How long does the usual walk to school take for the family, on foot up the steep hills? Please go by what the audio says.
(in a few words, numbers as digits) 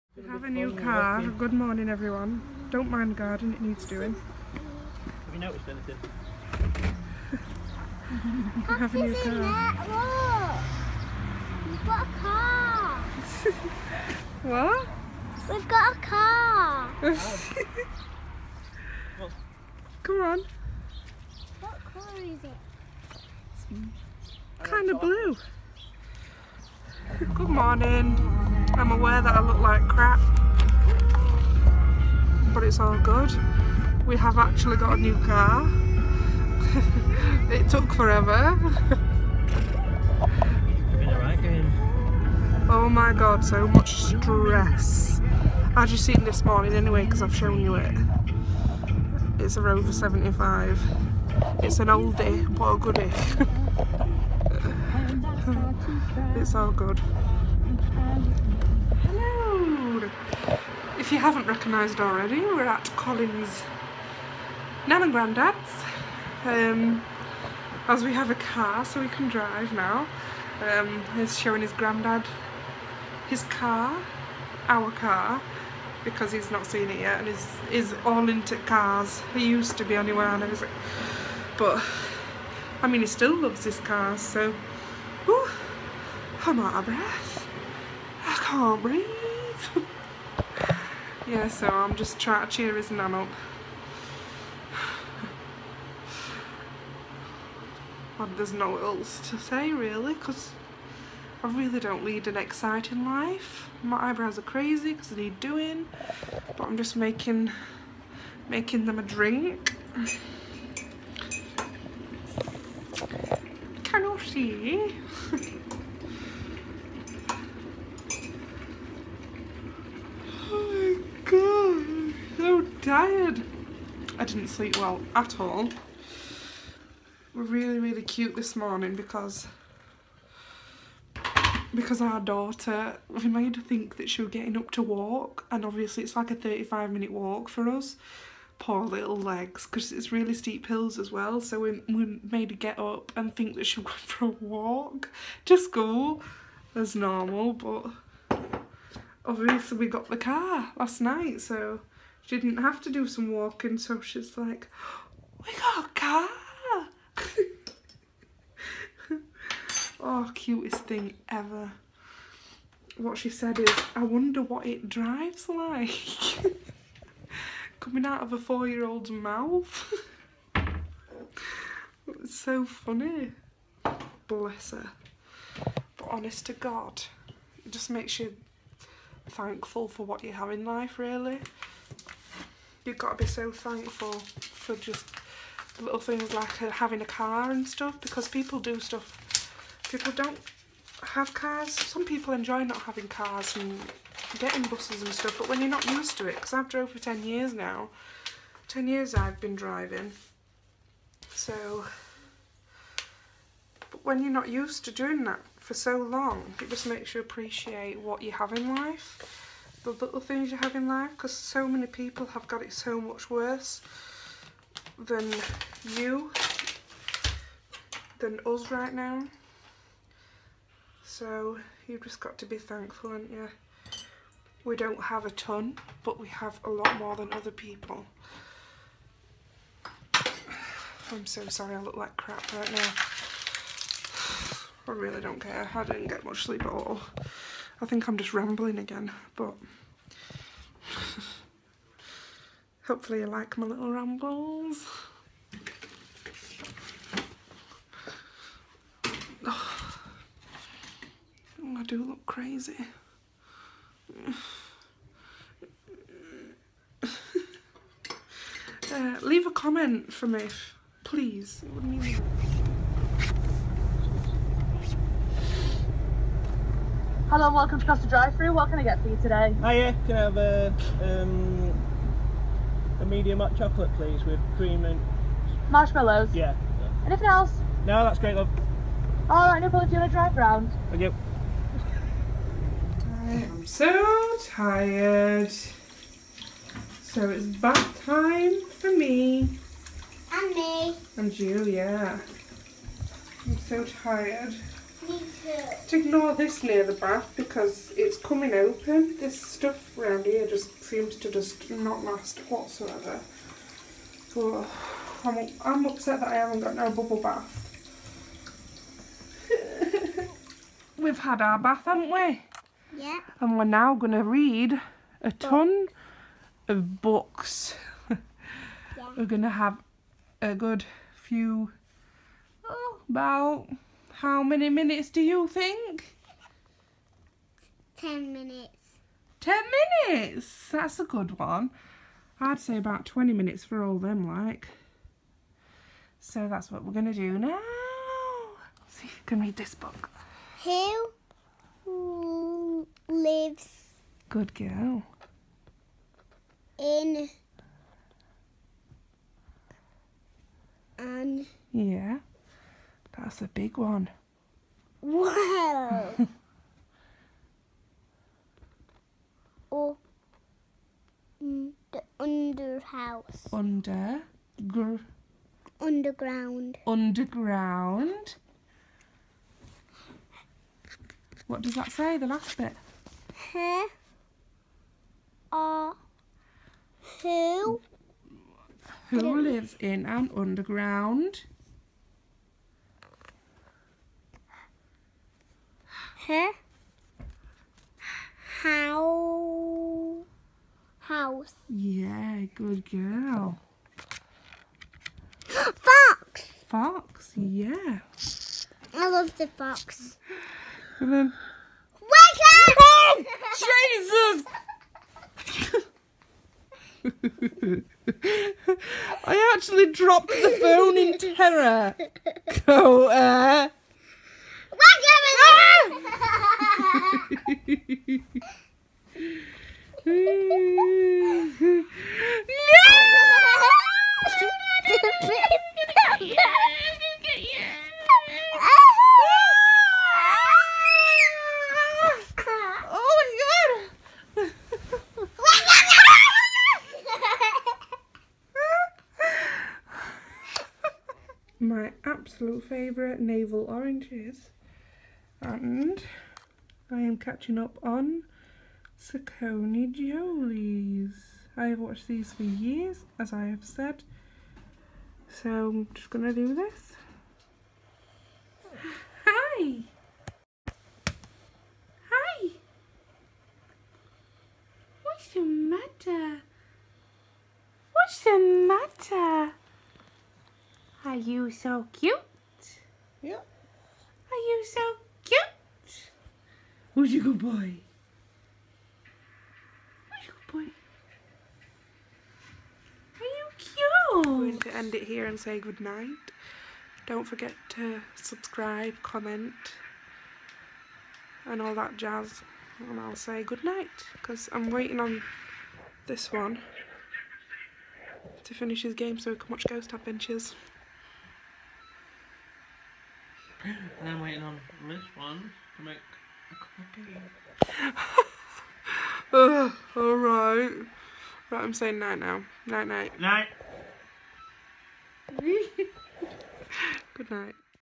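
35 minutes.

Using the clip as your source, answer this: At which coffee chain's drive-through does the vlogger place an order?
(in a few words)
Costa.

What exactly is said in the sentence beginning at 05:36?
So that's what we're going to do now.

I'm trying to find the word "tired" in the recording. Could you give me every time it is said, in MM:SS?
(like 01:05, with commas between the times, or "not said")
02:02, 04:44, 04:53.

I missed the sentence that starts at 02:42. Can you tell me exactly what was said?
What she said is, I wonder what it drives like.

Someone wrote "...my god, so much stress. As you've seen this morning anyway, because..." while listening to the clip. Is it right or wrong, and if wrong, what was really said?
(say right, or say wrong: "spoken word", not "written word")
right.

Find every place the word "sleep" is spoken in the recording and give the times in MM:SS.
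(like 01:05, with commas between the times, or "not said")
02:04, 03:56.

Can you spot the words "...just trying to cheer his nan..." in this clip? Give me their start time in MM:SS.
01:31.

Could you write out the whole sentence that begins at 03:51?
I'm so sorry I look like crap right now.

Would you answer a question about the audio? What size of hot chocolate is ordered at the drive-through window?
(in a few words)
Medium.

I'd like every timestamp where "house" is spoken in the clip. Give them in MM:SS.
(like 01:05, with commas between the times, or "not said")
06:02, 06:30.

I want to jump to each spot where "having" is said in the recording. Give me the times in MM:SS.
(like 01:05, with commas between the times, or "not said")
03:06, 03:12.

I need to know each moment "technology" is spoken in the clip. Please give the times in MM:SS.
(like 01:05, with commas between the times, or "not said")
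not said.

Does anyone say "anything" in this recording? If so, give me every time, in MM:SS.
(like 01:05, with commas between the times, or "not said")
00:05, 04:37.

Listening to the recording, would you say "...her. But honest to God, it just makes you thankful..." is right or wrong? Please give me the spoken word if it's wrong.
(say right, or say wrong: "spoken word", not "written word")
right.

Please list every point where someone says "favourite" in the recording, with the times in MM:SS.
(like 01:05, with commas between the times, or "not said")
07:22.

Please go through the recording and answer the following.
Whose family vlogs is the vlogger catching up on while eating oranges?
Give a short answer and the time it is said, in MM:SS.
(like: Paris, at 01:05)
Saccone Jolys, at 07:29.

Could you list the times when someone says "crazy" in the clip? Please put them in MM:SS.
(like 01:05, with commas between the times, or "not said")
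01:44, 04:12.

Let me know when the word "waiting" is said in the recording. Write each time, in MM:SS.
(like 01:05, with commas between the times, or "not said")
08:14, 08:24.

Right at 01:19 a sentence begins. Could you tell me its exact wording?
He used to be anywhere and everything, but I mean he still loves his car.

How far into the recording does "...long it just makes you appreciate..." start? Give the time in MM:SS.
03:25.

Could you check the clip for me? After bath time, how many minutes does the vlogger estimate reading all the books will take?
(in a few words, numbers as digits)
20 minutes.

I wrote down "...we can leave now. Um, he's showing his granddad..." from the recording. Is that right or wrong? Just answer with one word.
wrong.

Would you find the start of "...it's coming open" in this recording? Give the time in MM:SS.
04:57.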